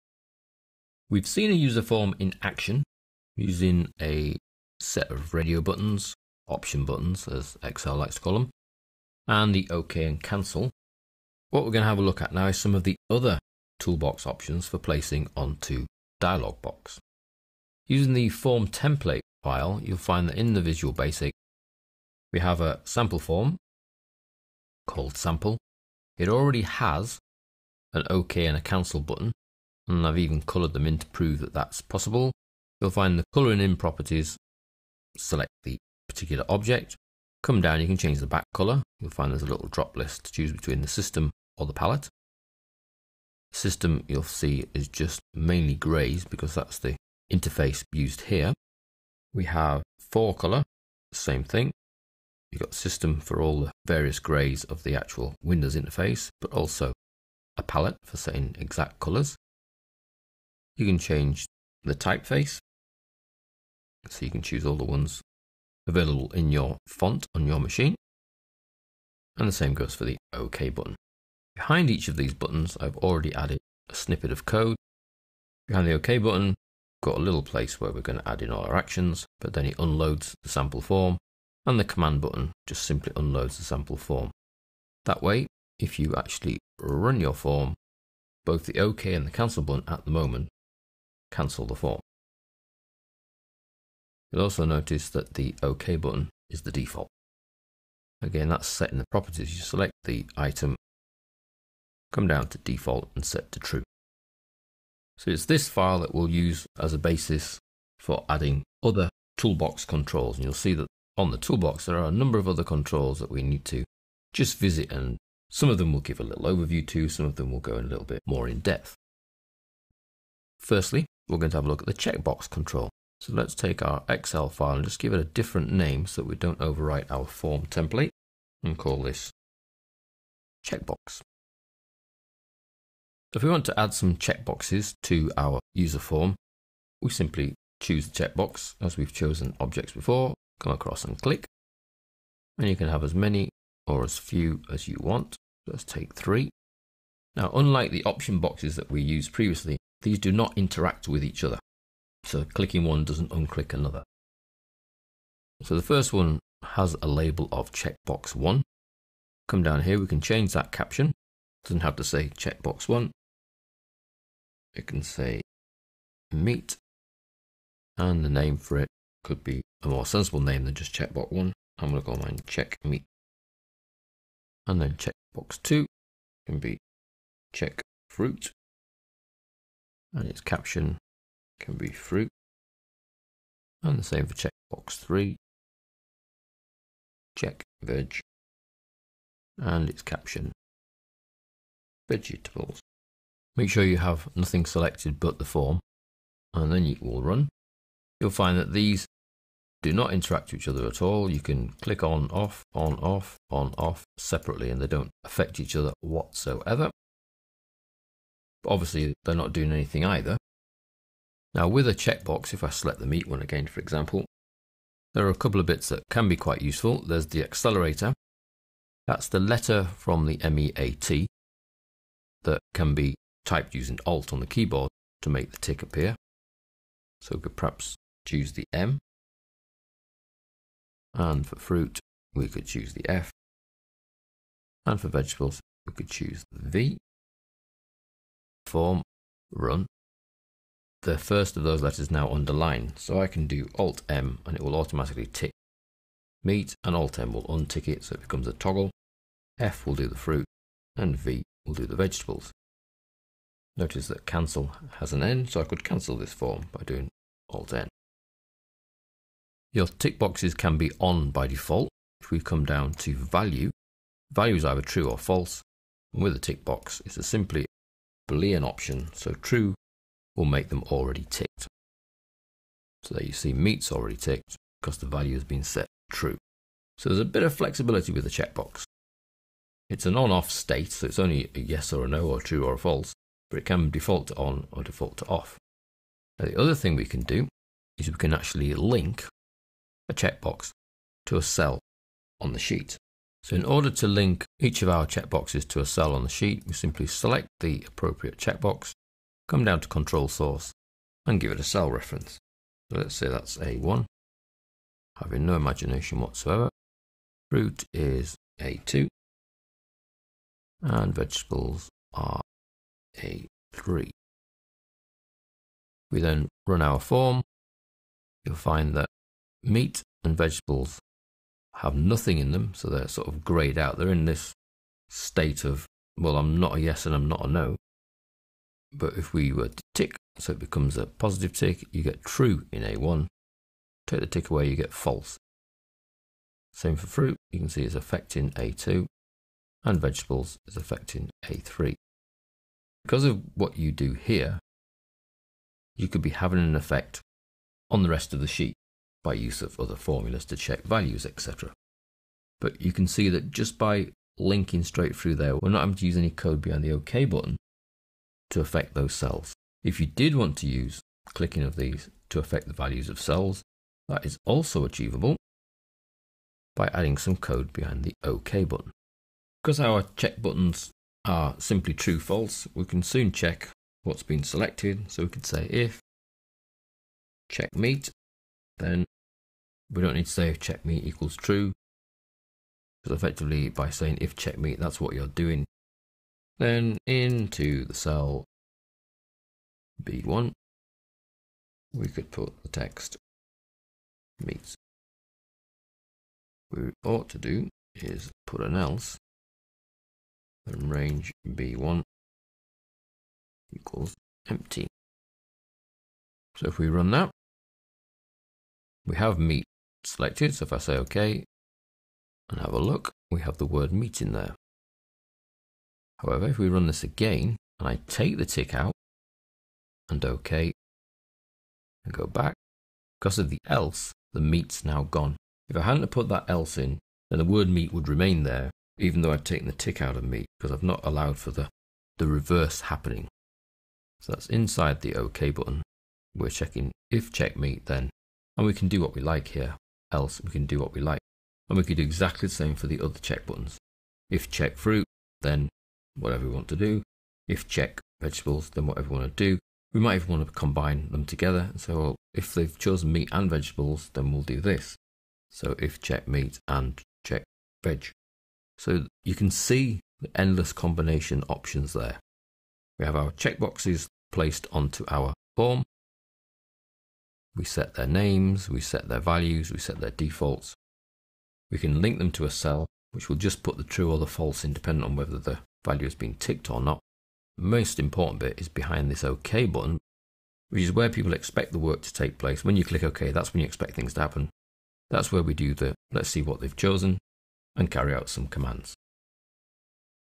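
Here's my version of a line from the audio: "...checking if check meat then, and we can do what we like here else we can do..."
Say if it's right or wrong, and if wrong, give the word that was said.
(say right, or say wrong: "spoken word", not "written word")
right.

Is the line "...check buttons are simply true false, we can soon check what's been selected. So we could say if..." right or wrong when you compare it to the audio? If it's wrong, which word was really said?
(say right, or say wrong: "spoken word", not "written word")
right.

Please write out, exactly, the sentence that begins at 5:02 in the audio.
So let's say that's A1, having no imagination whatsoever.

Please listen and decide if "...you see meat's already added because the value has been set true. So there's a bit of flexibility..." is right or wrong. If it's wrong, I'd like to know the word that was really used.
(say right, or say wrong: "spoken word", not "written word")
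wrong: "ticked", not "added".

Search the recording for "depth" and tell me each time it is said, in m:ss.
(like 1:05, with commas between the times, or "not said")
1:58.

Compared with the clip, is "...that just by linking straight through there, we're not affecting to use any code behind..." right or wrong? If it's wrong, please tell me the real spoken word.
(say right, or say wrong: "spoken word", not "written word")
wrong: "having", not "affecting".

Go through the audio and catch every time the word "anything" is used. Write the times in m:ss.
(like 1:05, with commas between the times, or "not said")
3:29.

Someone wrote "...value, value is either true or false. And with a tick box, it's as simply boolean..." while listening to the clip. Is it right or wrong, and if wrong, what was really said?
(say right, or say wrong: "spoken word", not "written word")
right.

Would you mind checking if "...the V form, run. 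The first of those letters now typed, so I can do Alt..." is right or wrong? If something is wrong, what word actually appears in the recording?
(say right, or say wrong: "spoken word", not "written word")
wrong: "underlined", not "typed".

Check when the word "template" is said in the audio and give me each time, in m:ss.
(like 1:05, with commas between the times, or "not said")
0:18, 2:07.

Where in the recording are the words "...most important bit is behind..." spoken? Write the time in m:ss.
7:57.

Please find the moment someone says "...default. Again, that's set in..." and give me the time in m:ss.
1:36.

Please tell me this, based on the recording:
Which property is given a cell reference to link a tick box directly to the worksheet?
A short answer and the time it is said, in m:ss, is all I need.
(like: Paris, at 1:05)
control source, at 4:59.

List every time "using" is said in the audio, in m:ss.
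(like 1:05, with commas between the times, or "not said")
0:03, 0:17, 3:43.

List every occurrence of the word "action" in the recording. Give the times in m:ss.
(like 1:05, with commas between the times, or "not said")
0:02, 1:18.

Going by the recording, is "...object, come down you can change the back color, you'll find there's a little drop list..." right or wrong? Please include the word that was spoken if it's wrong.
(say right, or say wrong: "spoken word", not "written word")
right.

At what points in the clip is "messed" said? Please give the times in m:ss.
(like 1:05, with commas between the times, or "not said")
not said.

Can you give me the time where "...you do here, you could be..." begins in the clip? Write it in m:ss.
5:43.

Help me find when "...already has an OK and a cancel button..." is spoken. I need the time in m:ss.
0:26.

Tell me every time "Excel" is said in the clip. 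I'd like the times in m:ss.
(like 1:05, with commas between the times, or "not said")
0:07, 2:04.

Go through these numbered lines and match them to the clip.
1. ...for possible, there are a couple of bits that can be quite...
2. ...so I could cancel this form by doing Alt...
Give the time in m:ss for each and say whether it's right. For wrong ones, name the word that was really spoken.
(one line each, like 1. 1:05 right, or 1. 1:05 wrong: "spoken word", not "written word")
1. 3:33 wrong: "example", not "possible"
2. 4:15 right.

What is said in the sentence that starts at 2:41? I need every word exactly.
Doesn't have to say checkbox 1.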